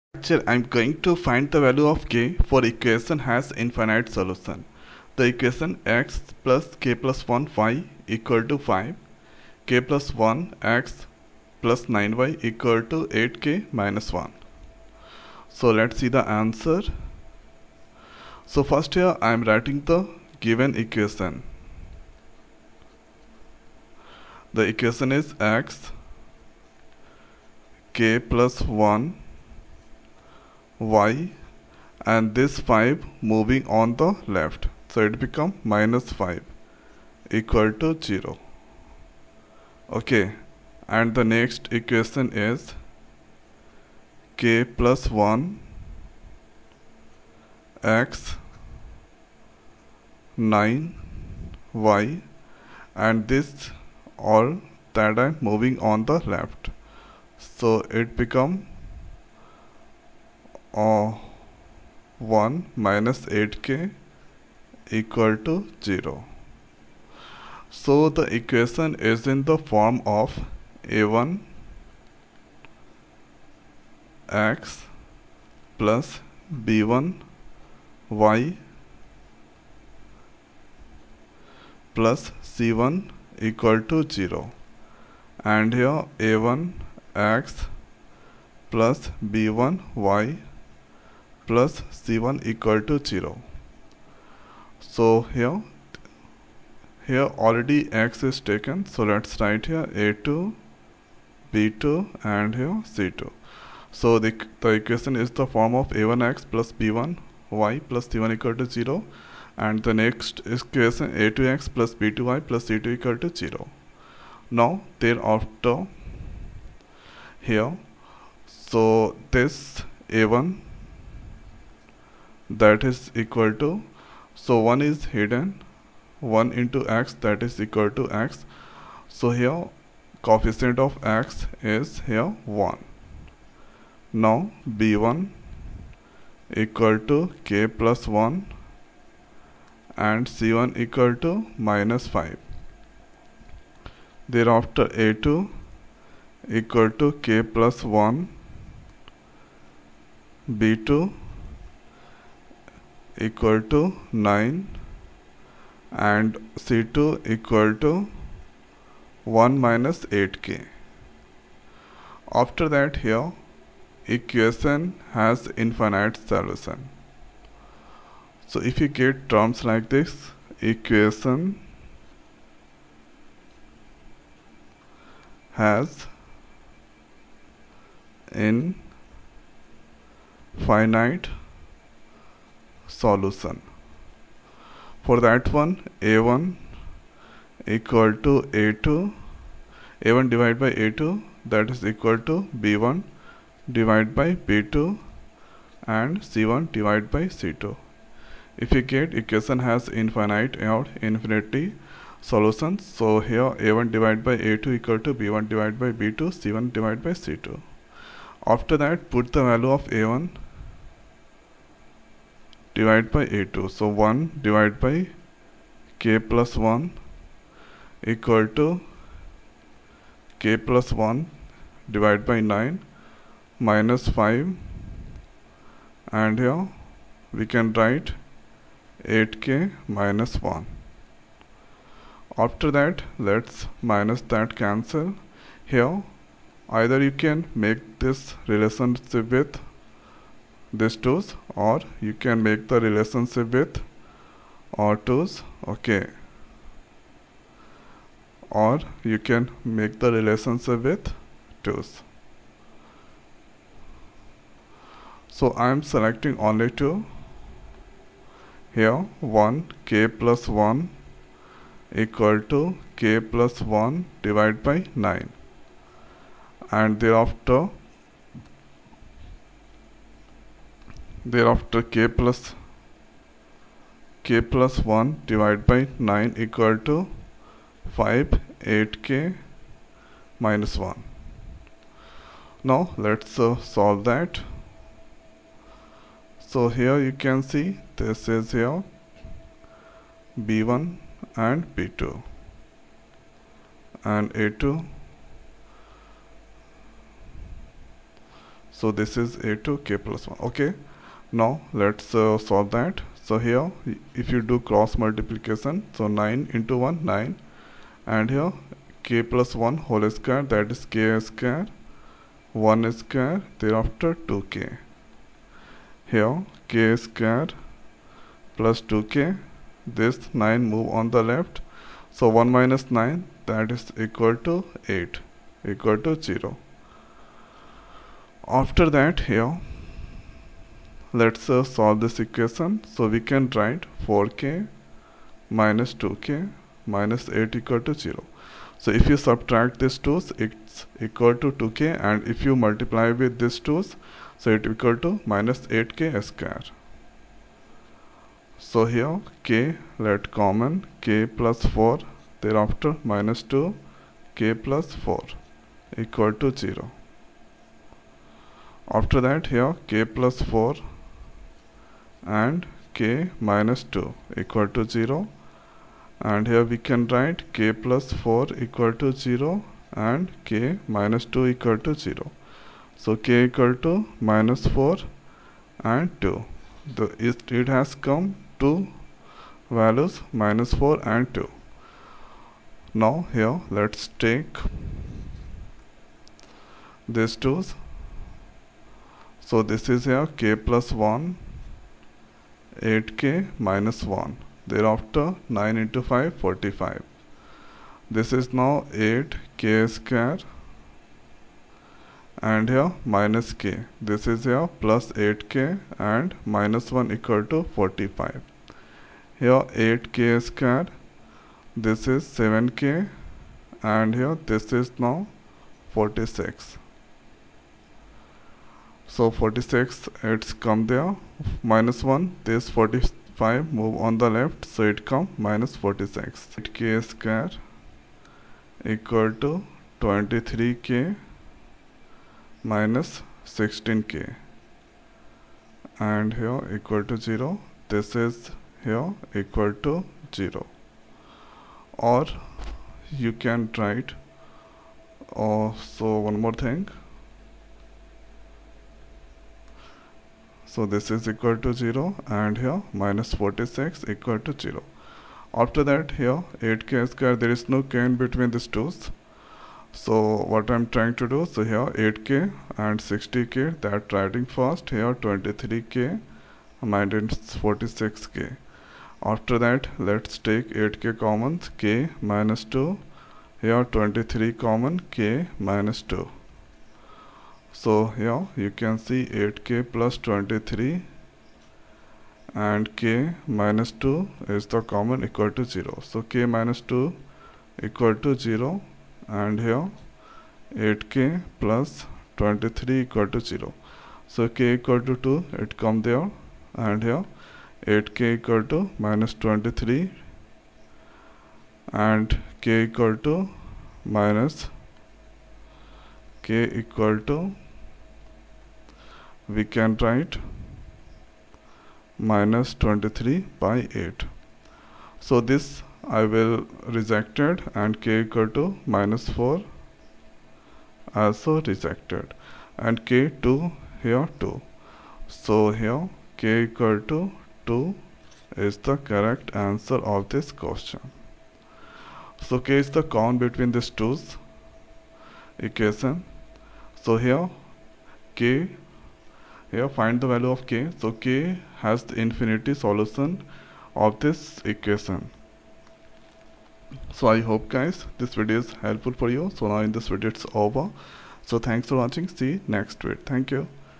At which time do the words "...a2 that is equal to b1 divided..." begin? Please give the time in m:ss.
3:10.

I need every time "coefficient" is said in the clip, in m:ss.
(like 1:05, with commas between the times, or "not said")
2:10.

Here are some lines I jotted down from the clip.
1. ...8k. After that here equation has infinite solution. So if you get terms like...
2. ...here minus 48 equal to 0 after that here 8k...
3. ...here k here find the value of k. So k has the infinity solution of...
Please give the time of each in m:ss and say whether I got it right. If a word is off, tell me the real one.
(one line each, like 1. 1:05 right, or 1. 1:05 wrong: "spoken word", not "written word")
1. 2:40 right
2. 7:32 wrong: "46", not "48"
3. 8:57 right.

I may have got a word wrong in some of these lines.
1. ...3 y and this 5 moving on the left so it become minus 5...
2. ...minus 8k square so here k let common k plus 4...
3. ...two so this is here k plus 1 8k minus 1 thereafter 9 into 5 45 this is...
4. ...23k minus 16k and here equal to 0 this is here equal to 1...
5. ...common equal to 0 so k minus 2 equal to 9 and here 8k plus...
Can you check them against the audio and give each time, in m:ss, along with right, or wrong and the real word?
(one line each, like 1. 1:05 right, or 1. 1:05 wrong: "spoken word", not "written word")
1. 0:28 wrong: "1", not "3"
2. 5:45 right
3. 6:27 right
4. 7:10 wrong: "0", not "1"
5. 8:04 wrong: "0", not "9".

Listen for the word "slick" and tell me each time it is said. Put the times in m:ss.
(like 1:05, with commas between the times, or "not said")
not said.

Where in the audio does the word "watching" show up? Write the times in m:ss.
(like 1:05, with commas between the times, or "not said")
9:11.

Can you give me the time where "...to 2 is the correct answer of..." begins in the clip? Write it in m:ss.
8:47.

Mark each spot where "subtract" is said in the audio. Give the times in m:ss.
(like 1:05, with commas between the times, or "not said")
5:39.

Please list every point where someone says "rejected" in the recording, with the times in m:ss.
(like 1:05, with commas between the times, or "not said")
8:36, 8:41.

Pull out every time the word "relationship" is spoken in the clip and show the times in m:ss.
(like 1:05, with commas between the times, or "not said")
3:58, 4:02, 4:10.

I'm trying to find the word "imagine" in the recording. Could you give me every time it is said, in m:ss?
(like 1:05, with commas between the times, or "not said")
not said.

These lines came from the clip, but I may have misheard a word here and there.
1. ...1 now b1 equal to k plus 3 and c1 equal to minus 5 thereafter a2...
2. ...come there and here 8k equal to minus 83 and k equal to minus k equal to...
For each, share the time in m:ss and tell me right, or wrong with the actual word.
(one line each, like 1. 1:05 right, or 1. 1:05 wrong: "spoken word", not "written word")
1. 2:12 wrong: "1", not "3"
2. 8:15 wrong: "23", not "83".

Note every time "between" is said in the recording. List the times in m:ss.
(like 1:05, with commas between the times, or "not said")
7:38, 8:53.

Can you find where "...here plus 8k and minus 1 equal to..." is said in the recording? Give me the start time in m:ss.
6:44.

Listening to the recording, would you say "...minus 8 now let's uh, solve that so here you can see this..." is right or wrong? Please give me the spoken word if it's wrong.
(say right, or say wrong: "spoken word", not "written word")
wrong: "1", not "8".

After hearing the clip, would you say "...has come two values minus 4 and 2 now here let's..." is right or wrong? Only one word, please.
right.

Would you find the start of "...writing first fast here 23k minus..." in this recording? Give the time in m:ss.
7:44.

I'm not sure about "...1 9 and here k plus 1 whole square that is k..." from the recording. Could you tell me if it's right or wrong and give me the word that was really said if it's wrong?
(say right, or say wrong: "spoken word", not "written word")
right.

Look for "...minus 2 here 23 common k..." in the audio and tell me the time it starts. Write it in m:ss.
7:52.